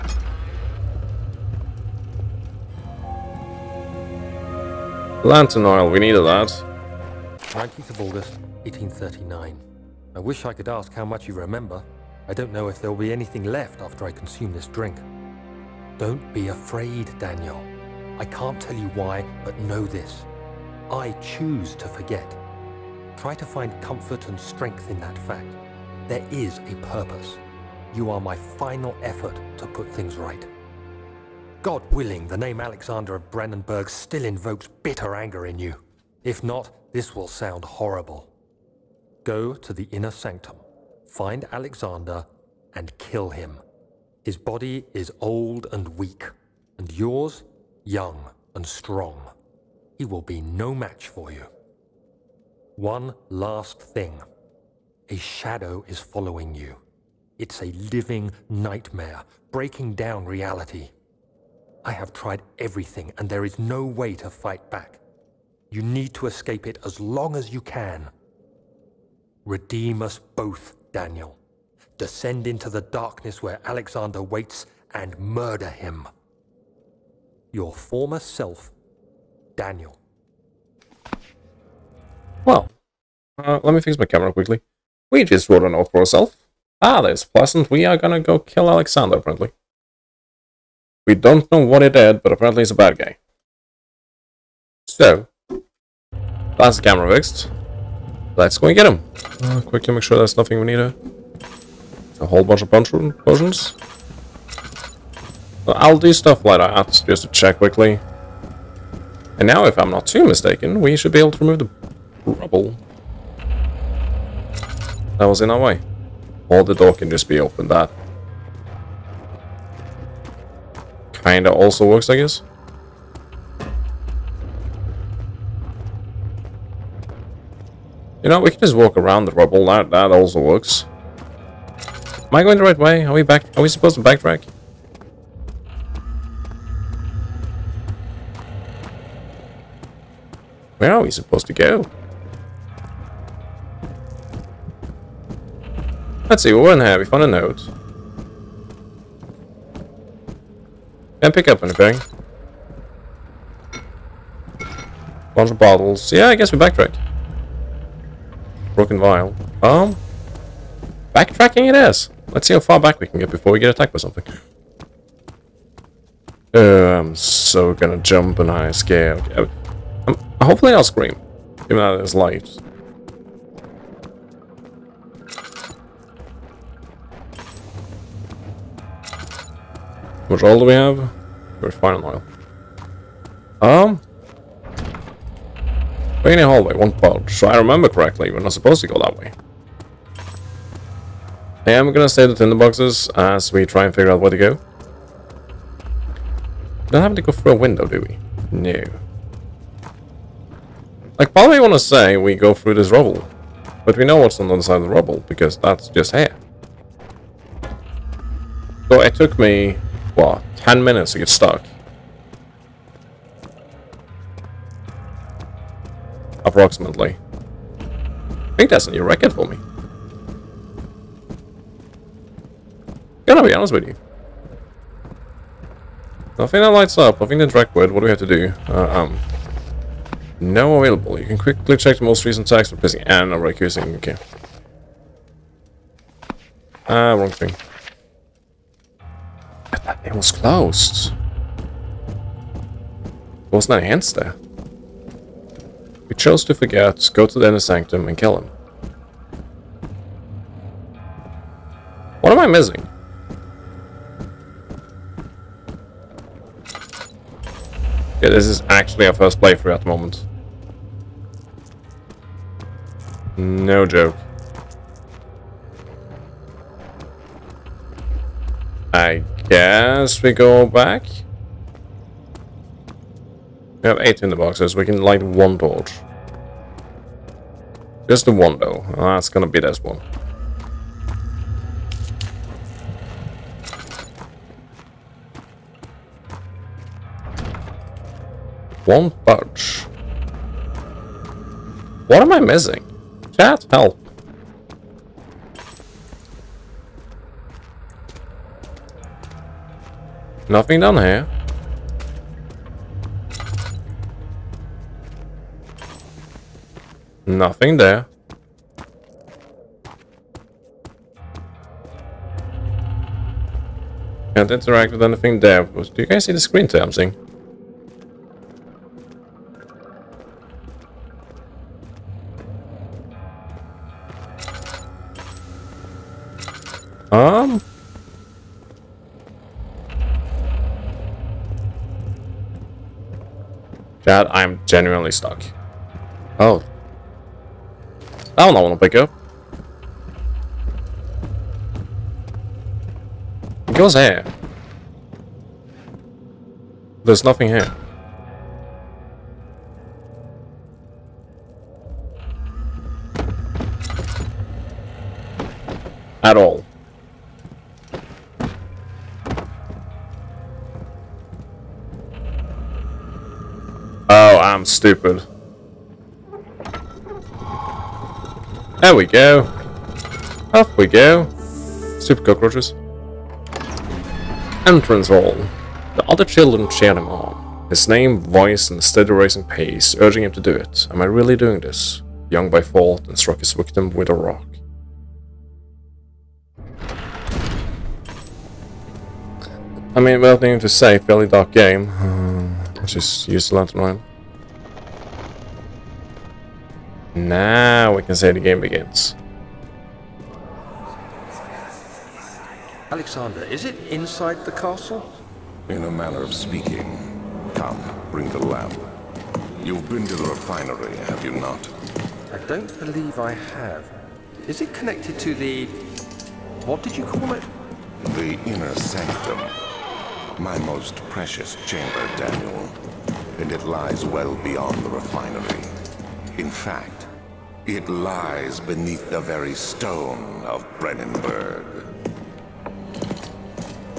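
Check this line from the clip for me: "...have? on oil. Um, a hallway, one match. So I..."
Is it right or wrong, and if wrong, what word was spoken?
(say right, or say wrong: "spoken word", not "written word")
wrong: "pouch", not "match".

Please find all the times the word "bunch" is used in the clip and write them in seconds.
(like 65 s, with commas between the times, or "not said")
102 s, 155 s.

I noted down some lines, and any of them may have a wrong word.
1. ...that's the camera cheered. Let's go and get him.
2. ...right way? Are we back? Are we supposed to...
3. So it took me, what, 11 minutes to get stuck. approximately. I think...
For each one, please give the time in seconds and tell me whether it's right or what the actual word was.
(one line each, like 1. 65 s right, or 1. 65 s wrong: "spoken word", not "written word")
1. 96 s wrong: "fixed", not "cheered"
2. 132 s right
3. 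208 s wrong: "10", not "11".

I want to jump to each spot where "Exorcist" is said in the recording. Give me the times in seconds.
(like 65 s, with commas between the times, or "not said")
not said.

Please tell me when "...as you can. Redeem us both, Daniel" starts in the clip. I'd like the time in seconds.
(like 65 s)
67 s.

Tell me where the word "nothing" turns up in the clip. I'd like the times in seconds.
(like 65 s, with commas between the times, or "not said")
100 s, 226 s, 300 s, 307 s, 347 s.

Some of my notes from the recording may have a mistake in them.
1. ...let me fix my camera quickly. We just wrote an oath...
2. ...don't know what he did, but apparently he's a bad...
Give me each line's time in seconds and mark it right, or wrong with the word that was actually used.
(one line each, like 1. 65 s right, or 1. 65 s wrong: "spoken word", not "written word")
1. 83 s right
2. 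91 s right.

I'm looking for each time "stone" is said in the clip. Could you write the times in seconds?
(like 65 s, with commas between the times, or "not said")
429 s.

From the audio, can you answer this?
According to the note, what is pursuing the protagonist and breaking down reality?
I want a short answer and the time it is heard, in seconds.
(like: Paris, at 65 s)
A shadow, at 55 s.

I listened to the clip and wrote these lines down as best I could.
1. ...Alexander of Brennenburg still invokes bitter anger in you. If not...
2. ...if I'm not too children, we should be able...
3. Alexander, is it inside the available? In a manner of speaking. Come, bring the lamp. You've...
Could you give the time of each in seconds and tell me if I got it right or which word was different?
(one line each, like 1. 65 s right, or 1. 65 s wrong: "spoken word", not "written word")
1. 32 s right
2. 109 s wrong: "mistaken", not "children"
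3. 402 s wrong: "castle", not "available".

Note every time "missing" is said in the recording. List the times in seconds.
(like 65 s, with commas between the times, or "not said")
252 s, 292 s.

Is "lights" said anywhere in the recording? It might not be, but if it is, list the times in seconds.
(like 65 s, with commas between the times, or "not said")
172 s, 226 s, 275 s.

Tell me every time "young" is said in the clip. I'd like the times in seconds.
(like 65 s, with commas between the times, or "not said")
47 s, 382 s.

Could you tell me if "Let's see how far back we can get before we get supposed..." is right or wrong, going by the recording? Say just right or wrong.
wrong.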